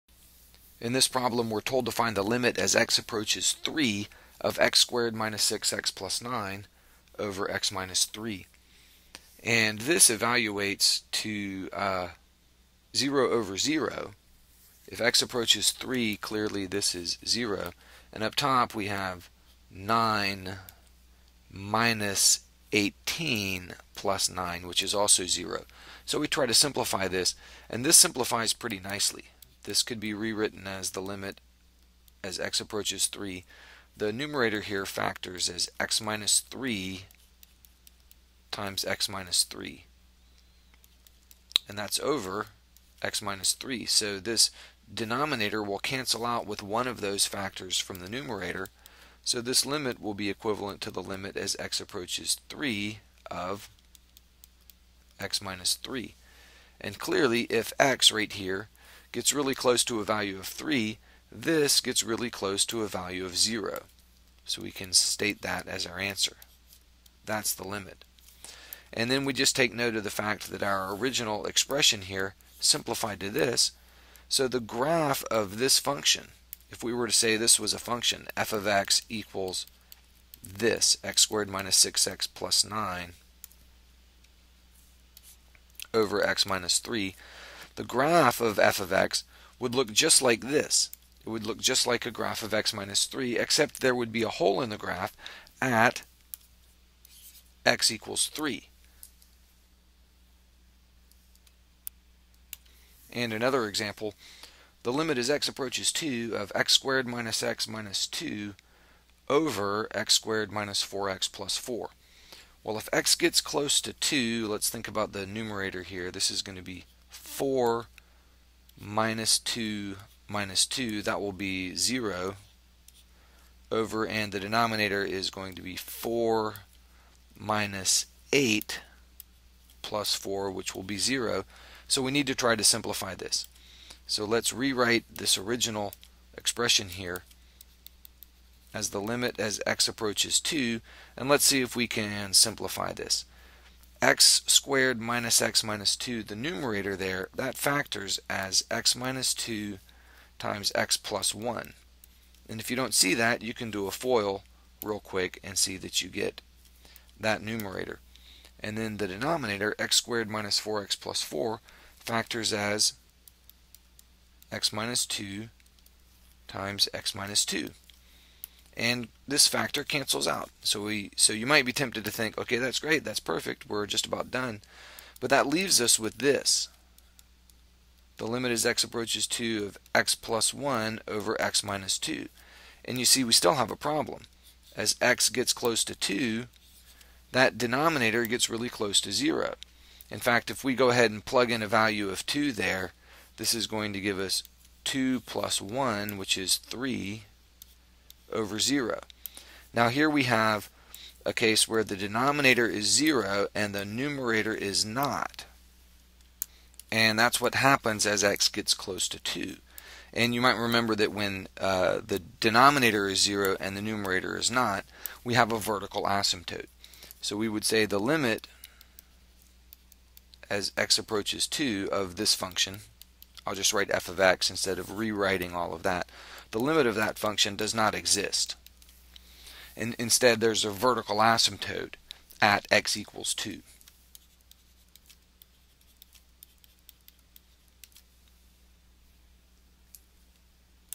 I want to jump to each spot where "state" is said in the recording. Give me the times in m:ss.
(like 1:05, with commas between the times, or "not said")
1:04.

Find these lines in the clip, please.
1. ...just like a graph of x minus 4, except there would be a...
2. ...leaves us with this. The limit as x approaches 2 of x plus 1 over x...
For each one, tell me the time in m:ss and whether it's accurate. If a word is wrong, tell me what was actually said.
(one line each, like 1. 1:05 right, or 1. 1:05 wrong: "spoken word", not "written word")
1. 1:31 wrong: "3", not "4"
2. 2:55 right.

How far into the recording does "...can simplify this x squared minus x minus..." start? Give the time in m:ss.
2:21.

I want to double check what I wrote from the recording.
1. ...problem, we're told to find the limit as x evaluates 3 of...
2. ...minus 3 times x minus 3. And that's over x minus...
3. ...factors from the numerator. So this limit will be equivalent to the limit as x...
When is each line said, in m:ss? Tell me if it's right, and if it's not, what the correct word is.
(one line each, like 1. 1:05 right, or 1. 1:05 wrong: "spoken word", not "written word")
1. 0:01 wrong: "approaches", not "evaluates"
2. 0:36 right
3. 0:47 right.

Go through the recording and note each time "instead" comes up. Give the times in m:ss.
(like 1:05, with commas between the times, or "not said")
3:44, 3:49.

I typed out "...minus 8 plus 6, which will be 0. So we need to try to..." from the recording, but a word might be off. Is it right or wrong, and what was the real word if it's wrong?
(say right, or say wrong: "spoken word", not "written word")
wrong: "4", not "6".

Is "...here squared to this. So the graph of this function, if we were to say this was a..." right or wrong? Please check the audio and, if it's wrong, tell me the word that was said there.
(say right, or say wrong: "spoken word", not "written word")
wrong: "simplified", not "squared".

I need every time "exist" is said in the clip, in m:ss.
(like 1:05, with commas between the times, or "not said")
3:47.